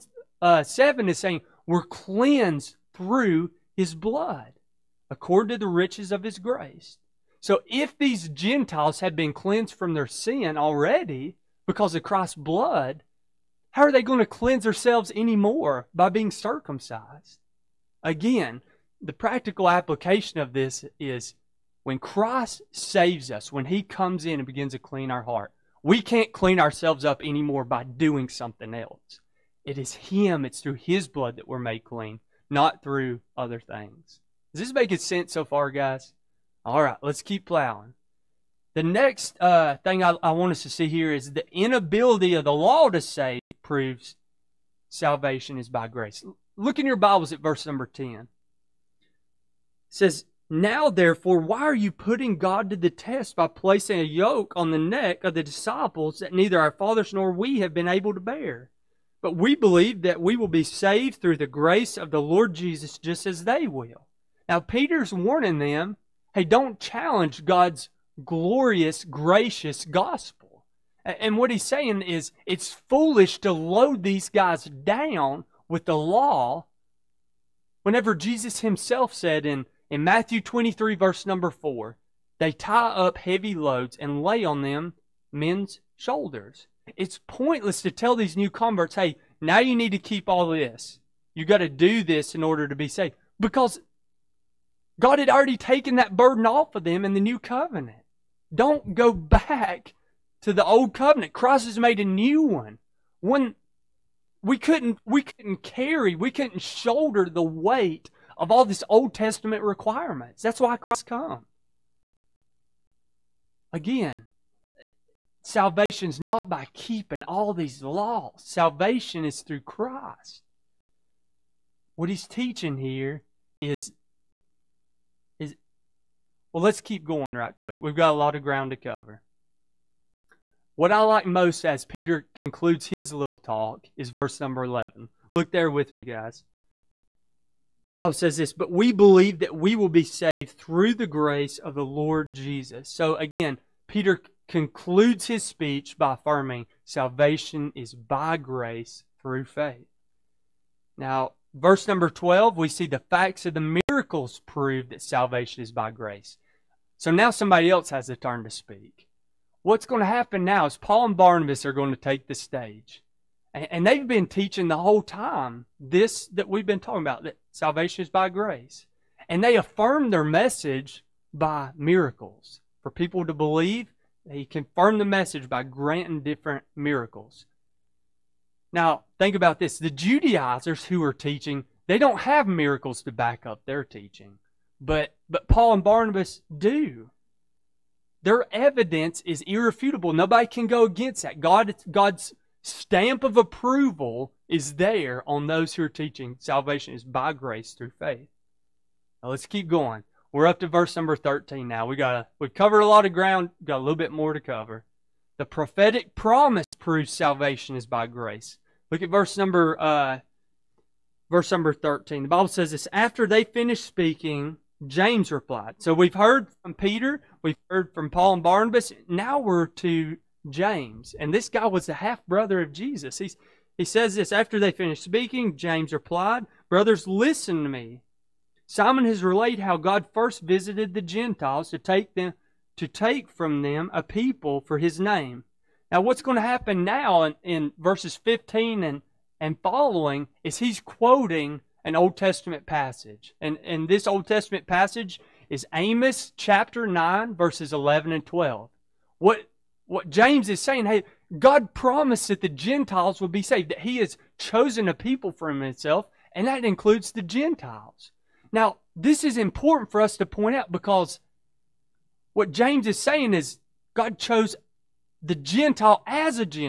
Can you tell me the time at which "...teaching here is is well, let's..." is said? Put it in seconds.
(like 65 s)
122 s.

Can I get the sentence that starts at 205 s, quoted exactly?
The prophetic promise proves salvation is by grace.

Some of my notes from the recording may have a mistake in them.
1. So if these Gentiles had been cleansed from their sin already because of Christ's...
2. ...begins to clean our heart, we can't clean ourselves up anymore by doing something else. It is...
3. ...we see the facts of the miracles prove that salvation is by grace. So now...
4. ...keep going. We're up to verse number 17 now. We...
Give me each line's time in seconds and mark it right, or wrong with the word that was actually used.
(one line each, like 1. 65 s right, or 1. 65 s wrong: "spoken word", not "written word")
1. 7 s right
2. 24 s right
3. 152 s right
4. 199 s wrong: "13", not "17".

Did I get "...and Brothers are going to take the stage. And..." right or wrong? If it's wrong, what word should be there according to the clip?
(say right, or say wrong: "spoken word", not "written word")
wrong: "Barnabas", not "Brothers".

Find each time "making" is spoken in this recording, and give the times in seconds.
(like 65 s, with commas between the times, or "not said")
34 s.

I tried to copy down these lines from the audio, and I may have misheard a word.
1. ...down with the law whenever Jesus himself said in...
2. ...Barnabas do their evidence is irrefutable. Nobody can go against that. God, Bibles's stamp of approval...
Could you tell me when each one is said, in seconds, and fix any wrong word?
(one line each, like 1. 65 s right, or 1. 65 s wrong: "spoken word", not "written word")
1. 74 s right
2. 185 s wrong: "God", not "Bibles".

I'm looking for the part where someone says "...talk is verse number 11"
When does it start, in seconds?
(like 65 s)
133 s.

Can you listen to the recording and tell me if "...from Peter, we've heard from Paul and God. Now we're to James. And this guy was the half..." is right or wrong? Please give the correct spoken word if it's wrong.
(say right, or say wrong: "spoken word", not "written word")
wrong: "Barnabas", not "God".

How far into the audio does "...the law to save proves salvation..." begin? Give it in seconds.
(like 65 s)
42 s.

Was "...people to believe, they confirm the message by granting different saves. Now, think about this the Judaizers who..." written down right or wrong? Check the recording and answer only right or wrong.
wrong.